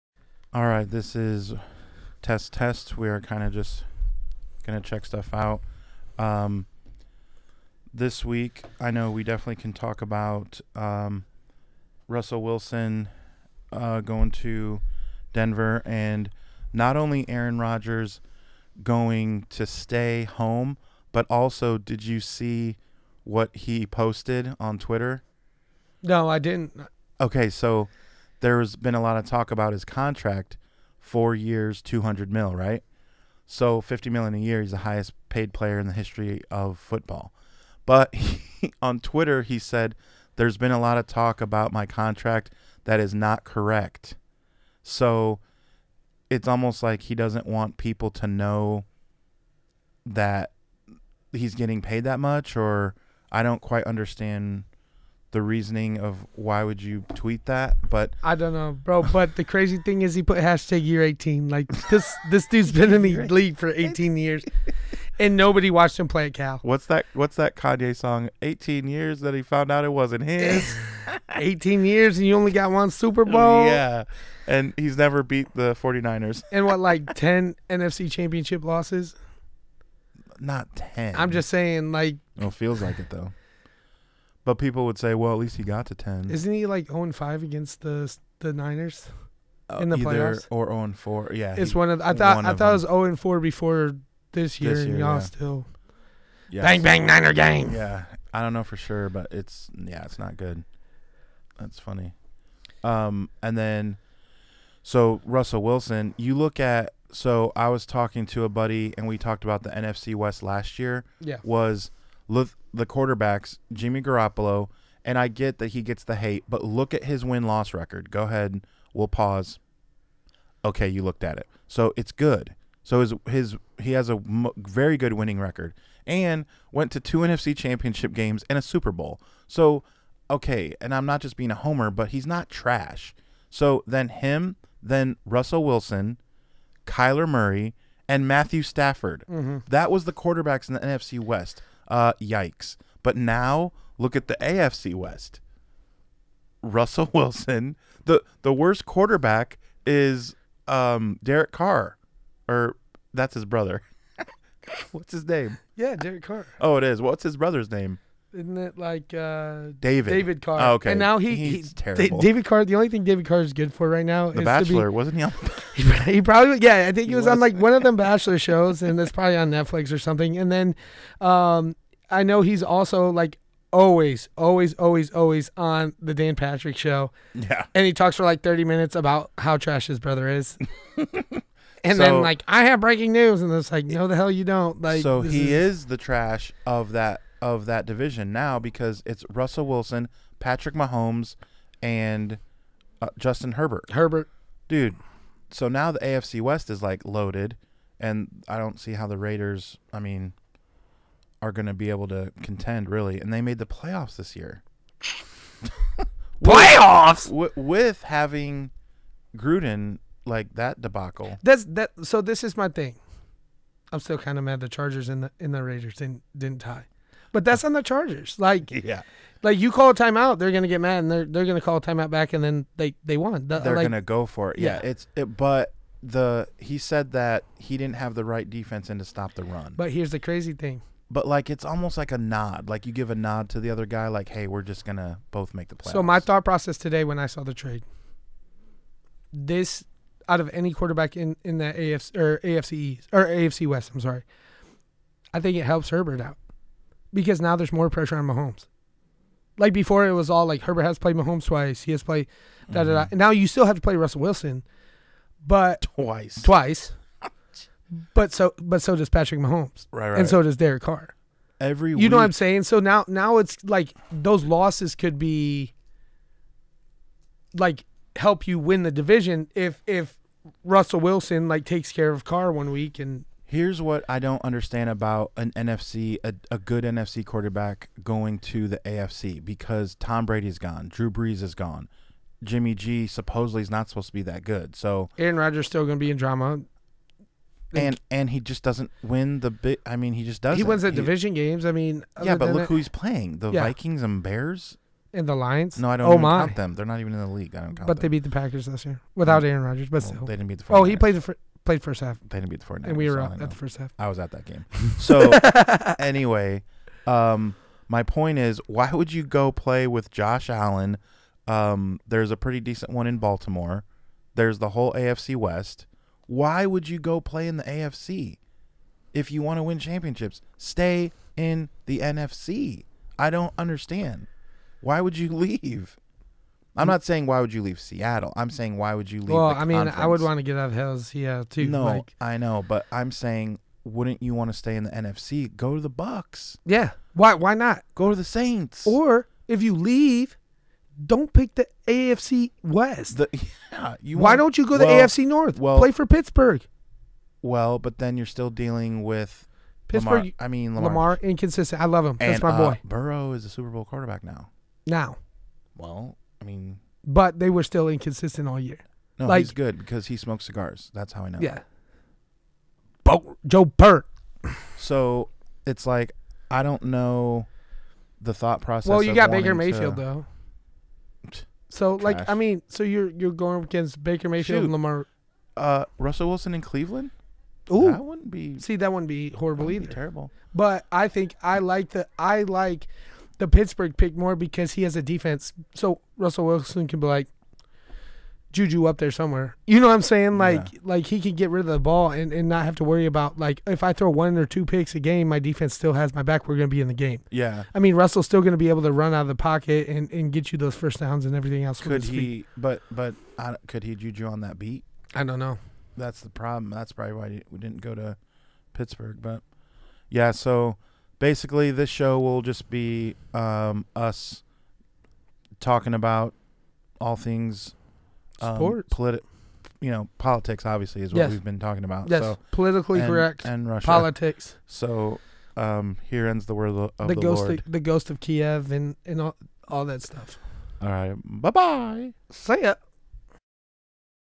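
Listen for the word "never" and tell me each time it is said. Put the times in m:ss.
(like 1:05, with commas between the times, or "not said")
1:14.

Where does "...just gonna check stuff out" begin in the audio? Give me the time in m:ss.
0:03.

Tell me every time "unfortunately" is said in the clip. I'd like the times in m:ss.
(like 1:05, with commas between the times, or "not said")
not said.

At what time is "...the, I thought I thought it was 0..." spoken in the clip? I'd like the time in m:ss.
1:31.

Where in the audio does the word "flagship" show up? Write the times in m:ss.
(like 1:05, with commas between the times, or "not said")
not said.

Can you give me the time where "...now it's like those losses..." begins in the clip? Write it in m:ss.
4:23.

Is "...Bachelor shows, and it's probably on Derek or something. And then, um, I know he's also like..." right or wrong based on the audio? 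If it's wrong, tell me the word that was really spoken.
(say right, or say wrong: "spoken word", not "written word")
wrong: "Netflix", not "Derek".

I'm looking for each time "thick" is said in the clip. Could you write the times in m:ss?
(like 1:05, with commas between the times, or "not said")
not said.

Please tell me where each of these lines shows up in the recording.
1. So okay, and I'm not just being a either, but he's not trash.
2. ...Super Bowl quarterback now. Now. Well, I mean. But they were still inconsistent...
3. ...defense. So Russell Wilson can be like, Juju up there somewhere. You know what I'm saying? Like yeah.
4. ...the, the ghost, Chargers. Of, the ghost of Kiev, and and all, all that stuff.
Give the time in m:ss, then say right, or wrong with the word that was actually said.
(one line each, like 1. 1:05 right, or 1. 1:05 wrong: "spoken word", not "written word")
1. 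2:09 wrong: "homer", not "either"
2. 5:53 right
3. 6:25 right
4. 7:06 wrong: "Lord", not "Chargers".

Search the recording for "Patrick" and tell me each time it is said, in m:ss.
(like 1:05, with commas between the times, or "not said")
2:56, 3:10, 4:19.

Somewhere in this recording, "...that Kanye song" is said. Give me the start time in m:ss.
1:07.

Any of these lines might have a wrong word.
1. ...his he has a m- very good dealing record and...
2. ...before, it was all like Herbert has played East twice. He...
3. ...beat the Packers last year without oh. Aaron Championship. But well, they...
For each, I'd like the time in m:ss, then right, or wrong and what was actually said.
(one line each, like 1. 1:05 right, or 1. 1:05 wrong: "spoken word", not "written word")
1. 2:03 wrong: "winning", not "dealing"
2. 4:09 wrong: "Mahomes", not "East"
3. 4:58 wrong: "Rodgers", not "Championship".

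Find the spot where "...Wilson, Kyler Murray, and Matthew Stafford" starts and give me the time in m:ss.
2:15.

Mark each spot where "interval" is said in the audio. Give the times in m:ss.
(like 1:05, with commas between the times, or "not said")
not said.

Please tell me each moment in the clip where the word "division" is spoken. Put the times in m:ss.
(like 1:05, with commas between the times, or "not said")
3:07, 4:28, 4:50.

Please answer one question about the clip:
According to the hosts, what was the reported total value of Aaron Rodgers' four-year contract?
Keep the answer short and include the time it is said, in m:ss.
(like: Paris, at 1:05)
200 million, at 0:31.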